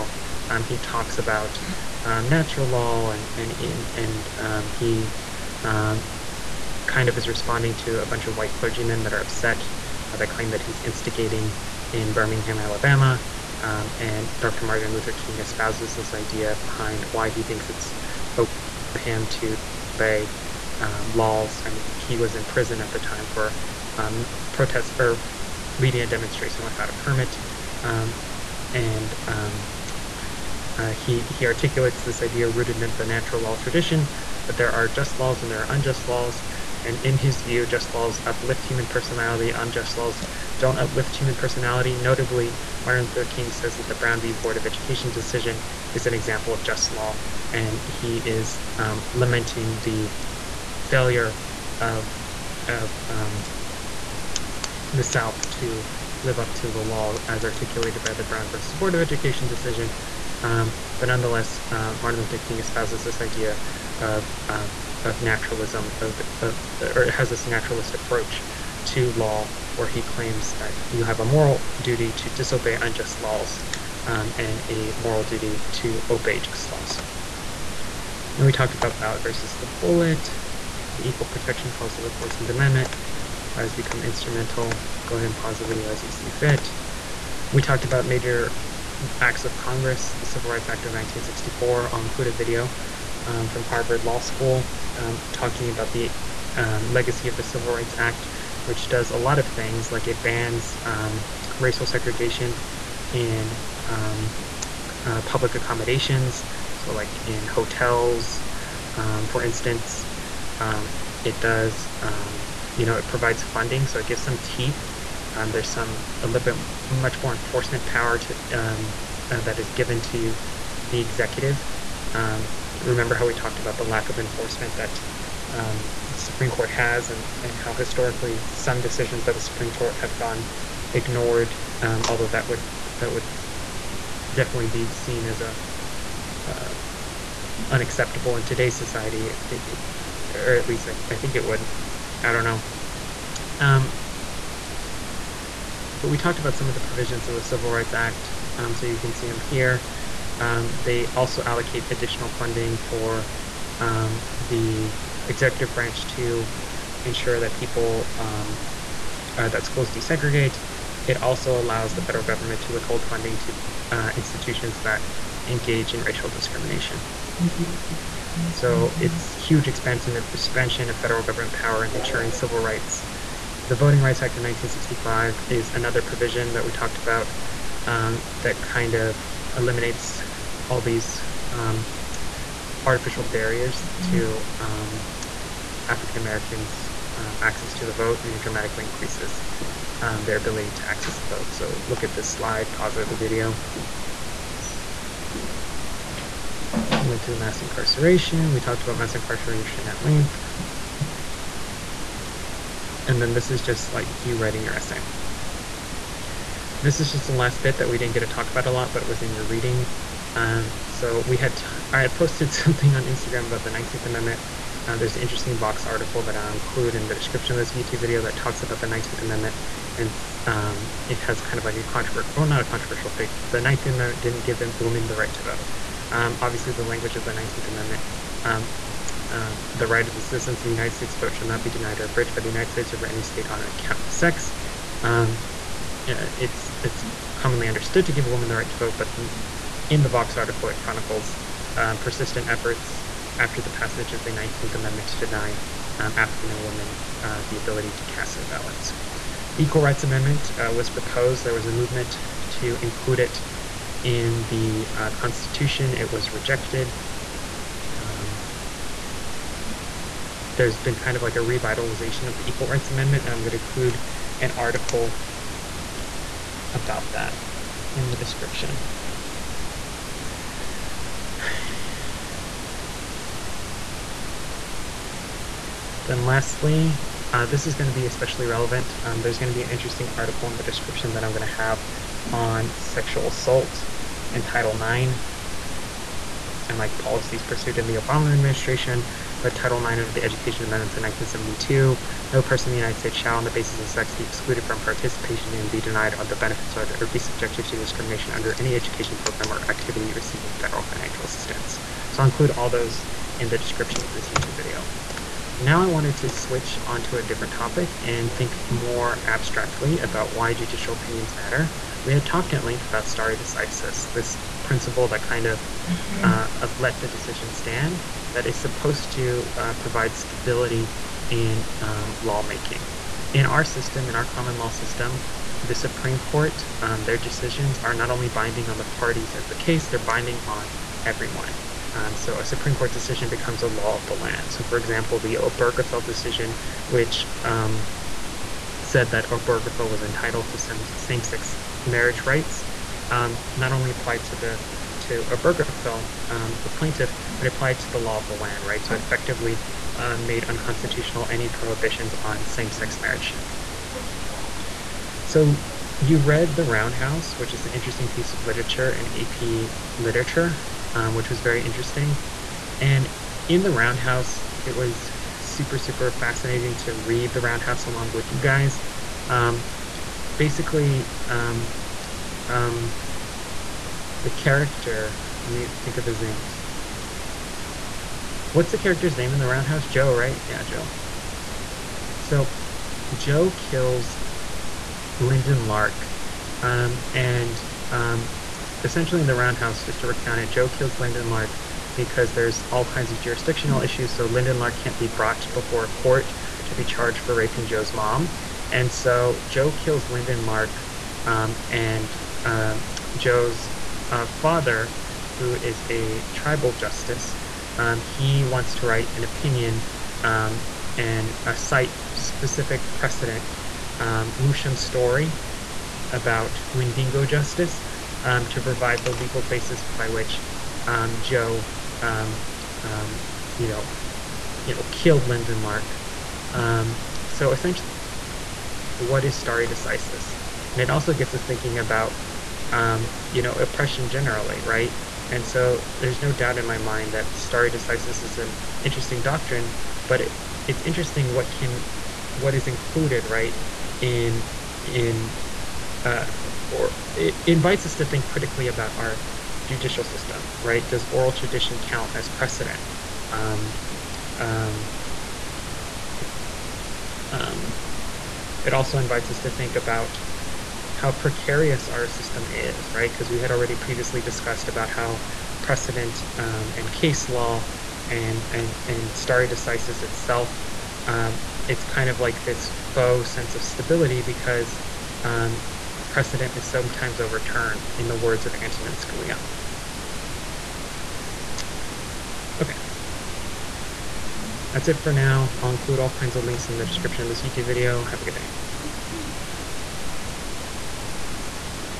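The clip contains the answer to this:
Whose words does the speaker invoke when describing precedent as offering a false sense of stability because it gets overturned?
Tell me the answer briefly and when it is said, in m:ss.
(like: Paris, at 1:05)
Antonin Scalia, at 7:58.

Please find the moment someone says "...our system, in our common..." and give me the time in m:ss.
5:23.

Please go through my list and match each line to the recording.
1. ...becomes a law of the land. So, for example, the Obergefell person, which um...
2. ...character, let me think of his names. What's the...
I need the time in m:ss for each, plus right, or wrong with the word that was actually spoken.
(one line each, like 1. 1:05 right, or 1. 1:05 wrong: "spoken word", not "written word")
1. 5:33 wrong: "decision", not "person"
2. 6:14 right.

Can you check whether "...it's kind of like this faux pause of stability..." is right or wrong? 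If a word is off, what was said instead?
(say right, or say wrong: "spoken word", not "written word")
wrong: "sense", not "pause".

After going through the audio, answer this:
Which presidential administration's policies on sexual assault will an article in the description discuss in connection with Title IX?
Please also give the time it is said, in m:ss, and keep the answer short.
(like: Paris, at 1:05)
Obama administration, at 4:47.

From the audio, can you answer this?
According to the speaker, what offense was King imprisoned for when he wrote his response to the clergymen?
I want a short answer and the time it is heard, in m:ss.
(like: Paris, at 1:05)
Leading a demonstration without a permit, at 0:25.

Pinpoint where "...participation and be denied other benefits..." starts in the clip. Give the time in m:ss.
4:54.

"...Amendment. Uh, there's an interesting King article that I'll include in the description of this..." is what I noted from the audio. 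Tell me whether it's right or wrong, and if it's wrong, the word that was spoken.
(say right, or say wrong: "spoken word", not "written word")
wrong: "Vox", not "King".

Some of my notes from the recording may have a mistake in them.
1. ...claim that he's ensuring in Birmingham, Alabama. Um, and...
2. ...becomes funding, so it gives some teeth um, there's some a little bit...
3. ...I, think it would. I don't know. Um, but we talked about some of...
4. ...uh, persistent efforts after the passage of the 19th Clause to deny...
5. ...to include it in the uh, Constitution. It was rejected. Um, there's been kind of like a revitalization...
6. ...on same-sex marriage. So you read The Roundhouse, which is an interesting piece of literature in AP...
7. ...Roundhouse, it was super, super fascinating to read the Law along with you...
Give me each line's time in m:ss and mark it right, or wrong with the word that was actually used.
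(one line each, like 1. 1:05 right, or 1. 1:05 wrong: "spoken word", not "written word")
1. 0:10 wrong: "instigating", not "ensuring"
2. 1:53 wrong: "provides", not "becomes"
3. 2:21 right
4. 4:01 wrong: "Amendment", not "Clause"
5. 4:12 right
6. 5:52 right
7. 6:03 wrong: "Roundhouse", not "Law".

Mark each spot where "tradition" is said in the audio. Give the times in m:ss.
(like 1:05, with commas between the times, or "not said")
0:33, 7:31.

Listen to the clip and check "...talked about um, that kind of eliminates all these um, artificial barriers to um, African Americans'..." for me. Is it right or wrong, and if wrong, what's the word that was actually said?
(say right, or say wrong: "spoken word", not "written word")
right.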